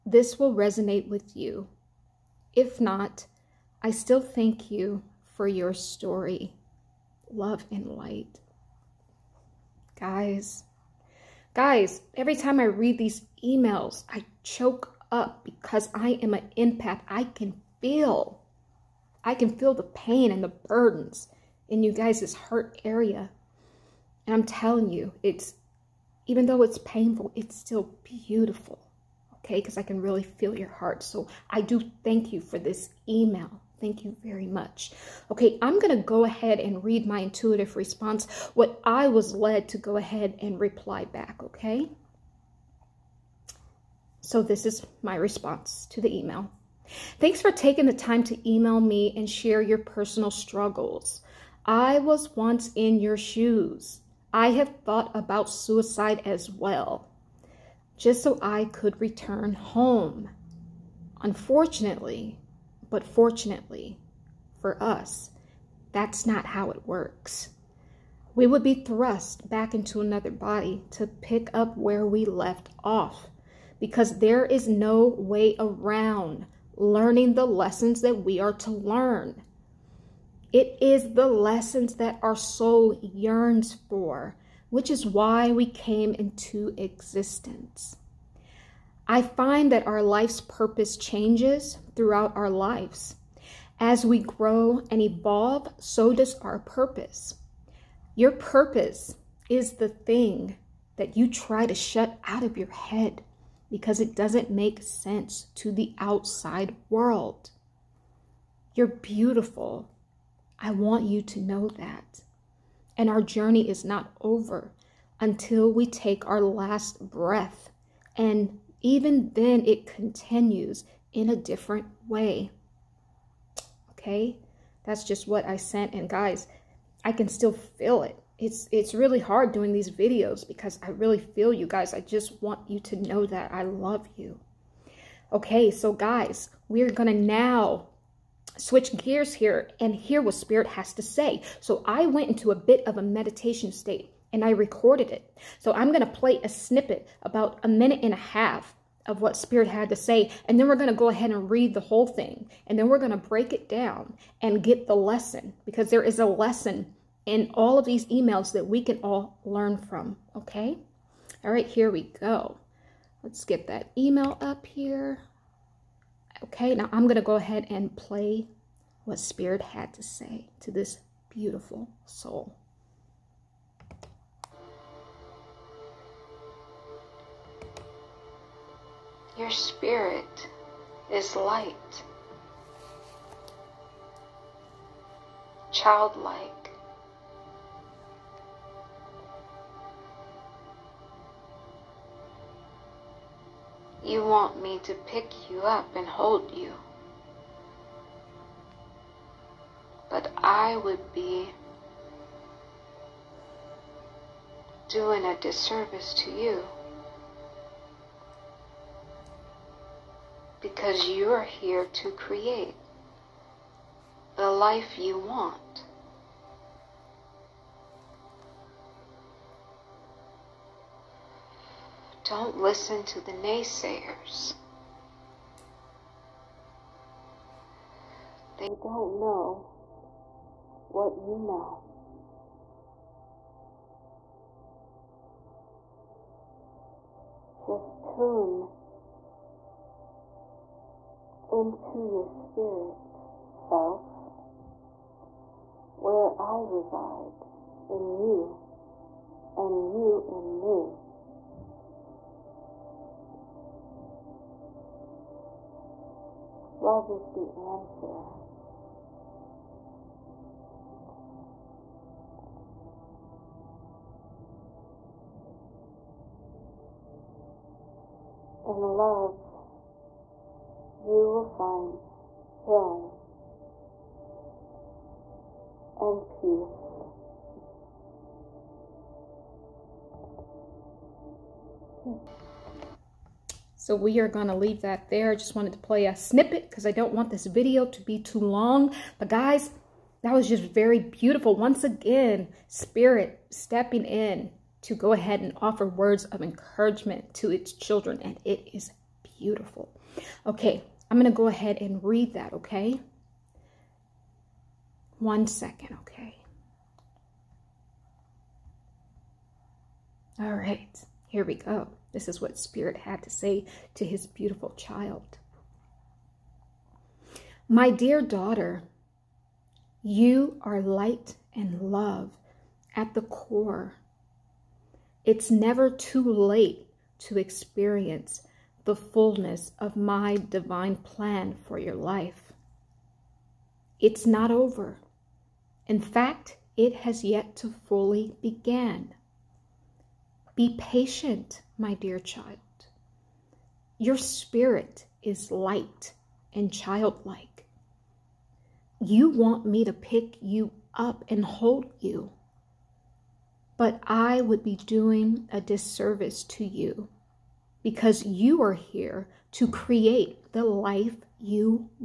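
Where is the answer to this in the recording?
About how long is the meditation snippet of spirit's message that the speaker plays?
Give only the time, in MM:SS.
02:27.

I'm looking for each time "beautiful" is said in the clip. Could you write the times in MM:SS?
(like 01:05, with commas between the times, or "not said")
00:28, 01:48, 02:51, 04:50, 04:59, 05:14.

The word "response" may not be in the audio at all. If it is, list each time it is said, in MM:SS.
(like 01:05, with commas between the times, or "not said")
00:37, 00:45.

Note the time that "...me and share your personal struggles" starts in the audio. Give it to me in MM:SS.
00:48.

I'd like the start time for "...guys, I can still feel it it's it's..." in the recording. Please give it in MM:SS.
02:06.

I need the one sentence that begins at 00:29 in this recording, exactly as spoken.
Okay, because I can really feel your heart.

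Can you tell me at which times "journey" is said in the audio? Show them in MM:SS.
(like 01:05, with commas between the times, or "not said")
01:53.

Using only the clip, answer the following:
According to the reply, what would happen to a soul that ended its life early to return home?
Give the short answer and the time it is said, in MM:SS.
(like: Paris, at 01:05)
thrust back into another body, at 01:08.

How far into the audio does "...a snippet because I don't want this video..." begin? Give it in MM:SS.
04:46.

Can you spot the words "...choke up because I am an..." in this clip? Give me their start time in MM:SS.
00:14.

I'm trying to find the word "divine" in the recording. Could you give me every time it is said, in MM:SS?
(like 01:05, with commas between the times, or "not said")
05:30.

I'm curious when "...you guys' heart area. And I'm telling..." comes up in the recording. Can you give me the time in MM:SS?
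00:21.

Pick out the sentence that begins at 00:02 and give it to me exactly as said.
If not, I still thank you for your story.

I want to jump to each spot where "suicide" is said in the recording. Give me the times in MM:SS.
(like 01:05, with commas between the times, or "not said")
00:55.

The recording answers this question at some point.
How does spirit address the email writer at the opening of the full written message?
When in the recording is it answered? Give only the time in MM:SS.
05:17.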